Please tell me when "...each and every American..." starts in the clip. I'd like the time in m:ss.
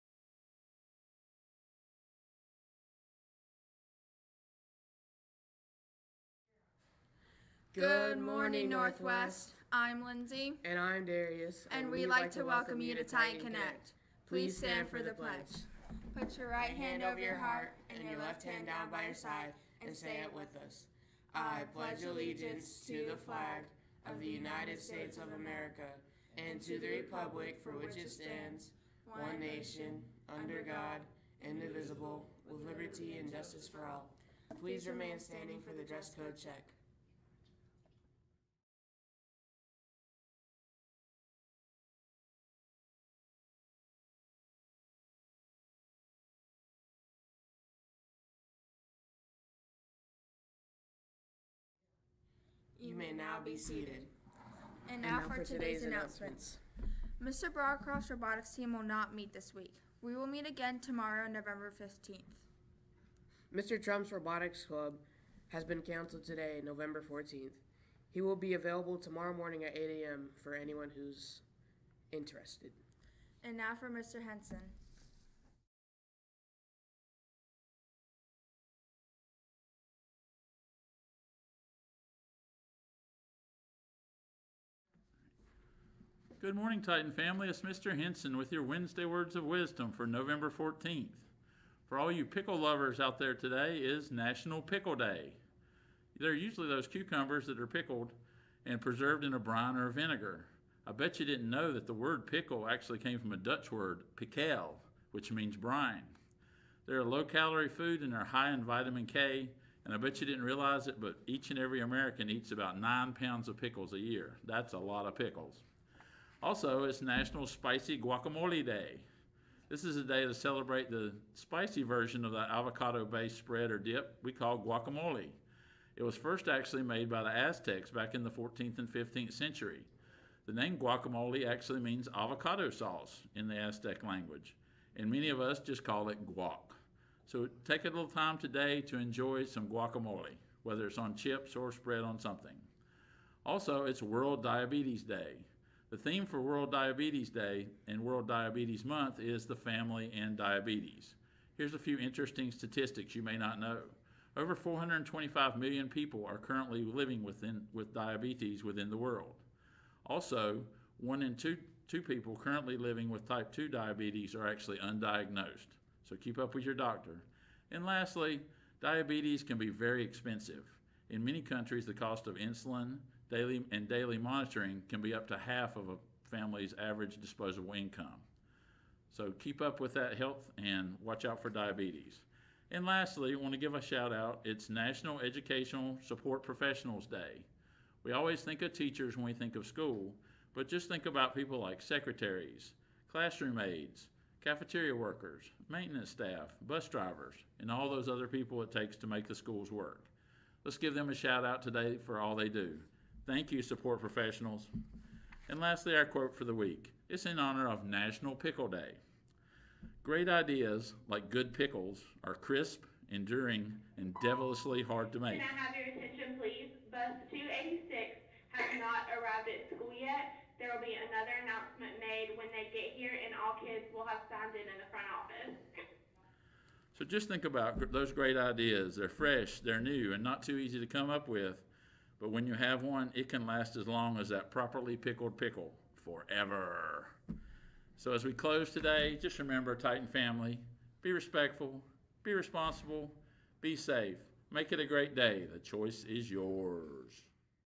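1:51.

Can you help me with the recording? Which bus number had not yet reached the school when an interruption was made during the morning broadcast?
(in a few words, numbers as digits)
286.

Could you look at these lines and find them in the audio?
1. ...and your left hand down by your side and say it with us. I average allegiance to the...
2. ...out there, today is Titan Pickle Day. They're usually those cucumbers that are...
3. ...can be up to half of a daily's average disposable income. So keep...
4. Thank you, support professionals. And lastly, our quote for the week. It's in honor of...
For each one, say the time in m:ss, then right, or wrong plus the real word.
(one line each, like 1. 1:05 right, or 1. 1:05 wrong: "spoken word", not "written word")
1. 0:17 wrong: "pledge", not "average"
2. 1:32 wrong: "National", not "Titan"
3. 2:54 wrong: "family", not "daily"
4. 3:23 right.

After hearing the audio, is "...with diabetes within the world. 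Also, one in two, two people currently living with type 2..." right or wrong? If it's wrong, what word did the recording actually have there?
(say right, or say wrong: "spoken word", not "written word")
right.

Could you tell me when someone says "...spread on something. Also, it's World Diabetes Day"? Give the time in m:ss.
2:21.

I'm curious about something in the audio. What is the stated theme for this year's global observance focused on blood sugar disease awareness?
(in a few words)
The family and diabetes.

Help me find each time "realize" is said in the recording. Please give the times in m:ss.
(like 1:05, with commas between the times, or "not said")
1:50.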